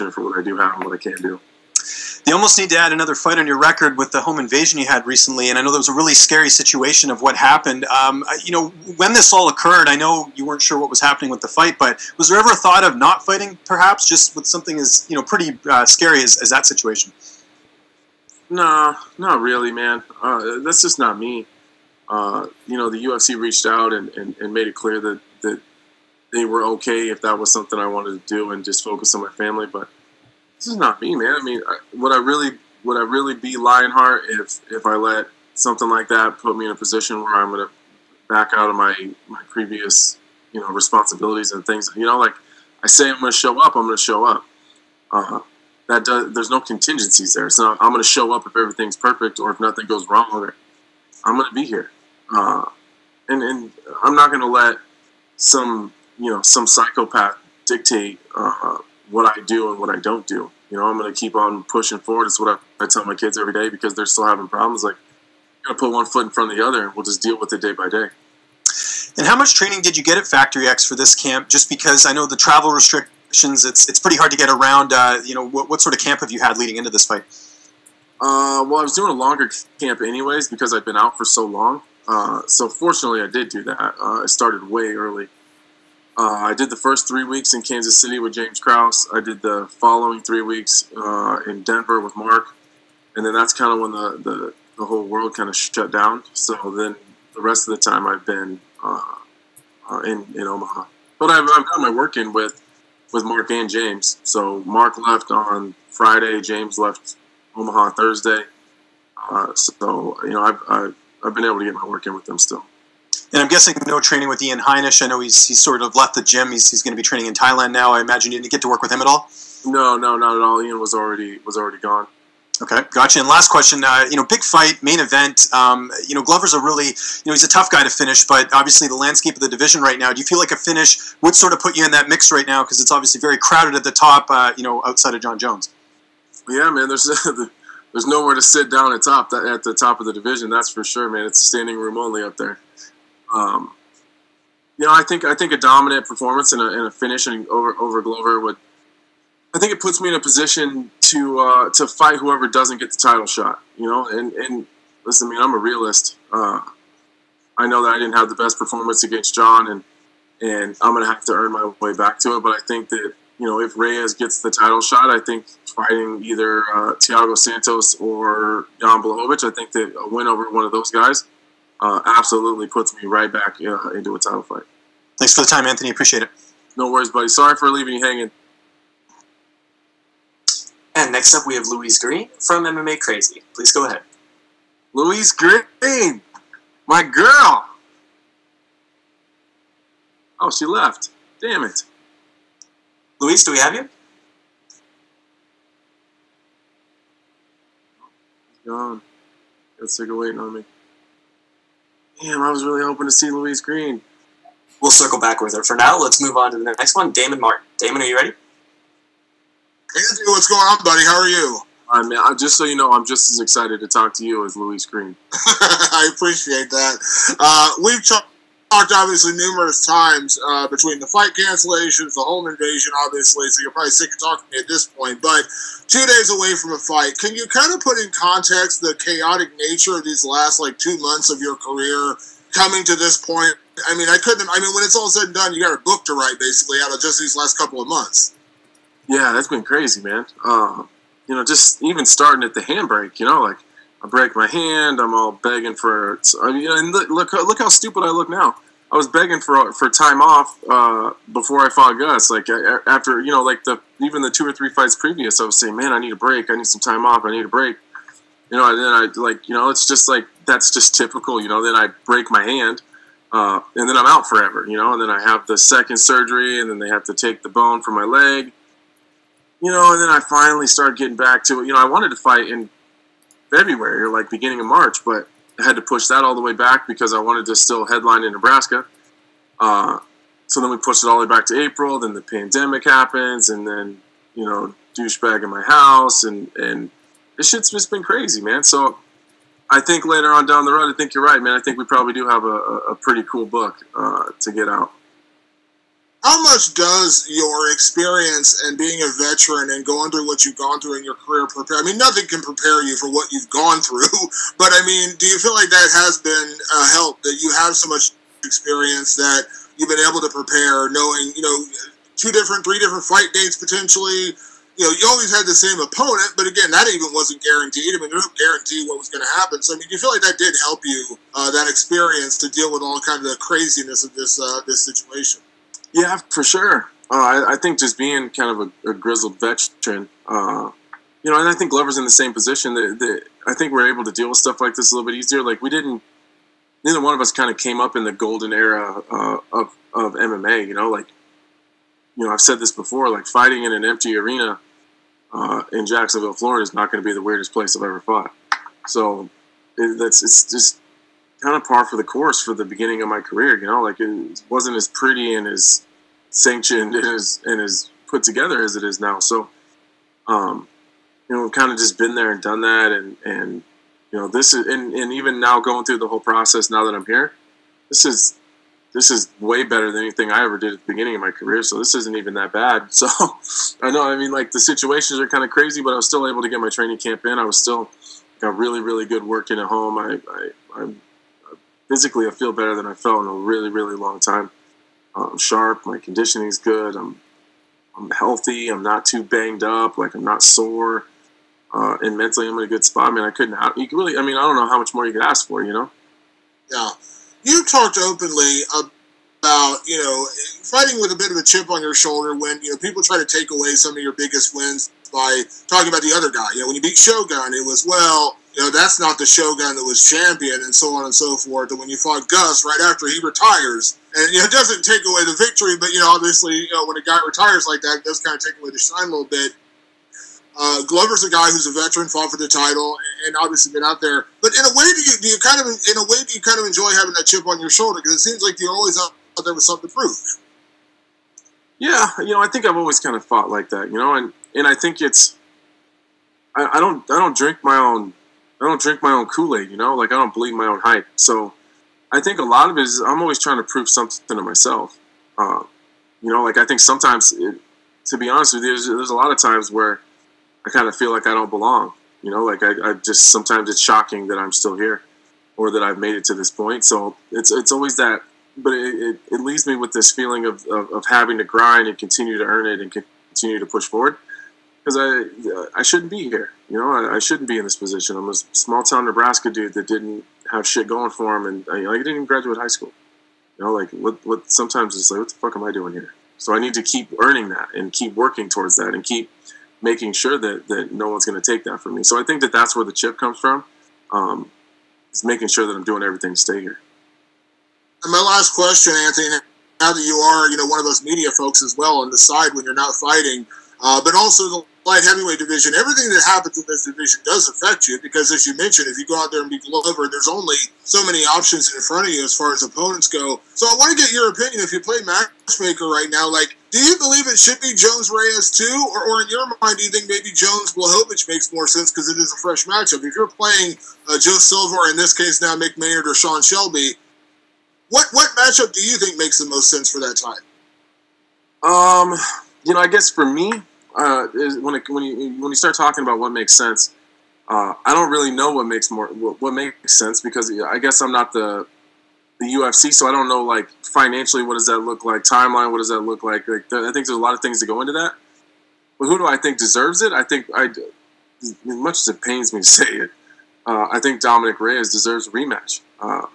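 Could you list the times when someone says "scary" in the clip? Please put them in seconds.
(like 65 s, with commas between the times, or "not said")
6 s, 15 s.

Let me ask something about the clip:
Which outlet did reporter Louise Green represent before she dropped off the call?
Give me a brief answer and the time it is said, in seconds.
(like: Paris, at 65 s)
MMA Crazy, at 182 s.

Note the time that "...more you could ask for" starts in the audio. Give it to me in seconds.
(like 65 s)
394 s.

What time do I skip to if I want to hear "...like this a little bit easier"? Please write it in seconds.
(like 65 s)
334 s.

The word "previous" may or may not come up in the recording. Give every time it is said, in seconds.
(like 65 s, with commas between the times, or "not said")
39 s, 254 s.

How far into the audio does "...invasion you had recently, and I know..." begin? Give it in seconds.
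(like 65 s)
4 s.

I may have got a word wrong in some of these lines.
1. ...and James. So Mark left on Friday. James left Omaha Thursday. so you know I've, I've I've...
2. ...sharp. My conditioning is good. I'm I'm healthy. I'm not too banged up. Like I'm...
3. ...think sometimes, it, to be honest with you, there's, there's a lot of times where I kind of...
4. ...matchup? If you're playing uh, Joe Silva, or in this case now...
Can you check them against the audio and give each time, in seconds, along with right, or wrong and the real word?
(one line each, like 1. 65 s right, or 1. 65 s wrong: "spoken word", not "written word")
1. 103 s right
2. 385 s right
3. 446 s right
4. 512 s right.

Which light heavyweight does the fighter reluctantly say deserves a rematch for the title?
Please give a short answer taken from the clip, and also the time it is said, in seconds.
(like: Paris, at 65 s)
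Dominick Reyes, at 544 s.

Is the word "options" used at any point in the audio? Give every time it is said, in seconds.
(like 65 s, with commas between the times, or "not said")
501 s.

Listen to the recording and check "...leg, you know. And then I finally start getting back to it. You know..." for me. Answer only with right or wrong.
right.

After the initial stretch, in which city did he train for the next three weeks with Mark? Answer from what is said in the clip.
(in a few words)
Denver.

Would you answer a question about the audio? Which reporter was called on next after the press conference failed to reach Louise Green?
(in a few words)
Damon Martin.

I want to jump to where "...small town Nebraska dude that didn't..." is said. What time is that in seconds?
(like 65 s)
468 s.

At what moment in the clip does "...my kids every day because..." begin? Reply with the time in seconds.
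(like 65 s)
63 s.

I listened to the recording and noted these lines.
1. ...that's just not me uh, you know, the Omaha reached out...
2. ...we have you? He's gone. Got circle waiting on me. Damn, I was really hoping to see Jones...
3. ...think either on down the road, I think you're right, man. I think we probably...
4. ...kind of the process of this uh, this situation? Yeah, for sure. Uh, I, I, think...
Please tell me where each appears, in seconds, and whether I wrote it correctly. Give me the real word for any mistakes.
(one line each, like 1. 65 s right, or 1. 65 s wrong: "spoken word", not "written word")
1. 20 s wrong: "UFC", not "Omaha"
2. 193 s wrong: "Louise", not "Jones"
3. 289 s wrong: "later", not "either"
4. 323 s wrong: "craziness", not "process".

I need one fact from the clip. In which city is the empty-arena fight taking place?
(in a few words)
Jacksonville.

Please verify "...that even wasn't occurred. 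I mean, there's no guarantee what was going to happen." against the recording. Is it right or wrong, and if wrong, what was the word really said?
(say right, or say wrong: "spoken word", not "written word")
wrong: "guaranteed", not "occurred".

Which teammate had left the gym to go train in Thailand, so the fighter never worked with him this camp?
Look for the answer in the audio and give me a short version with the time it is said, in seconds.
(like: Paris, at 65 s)
Ian Heinisch, at 114 s.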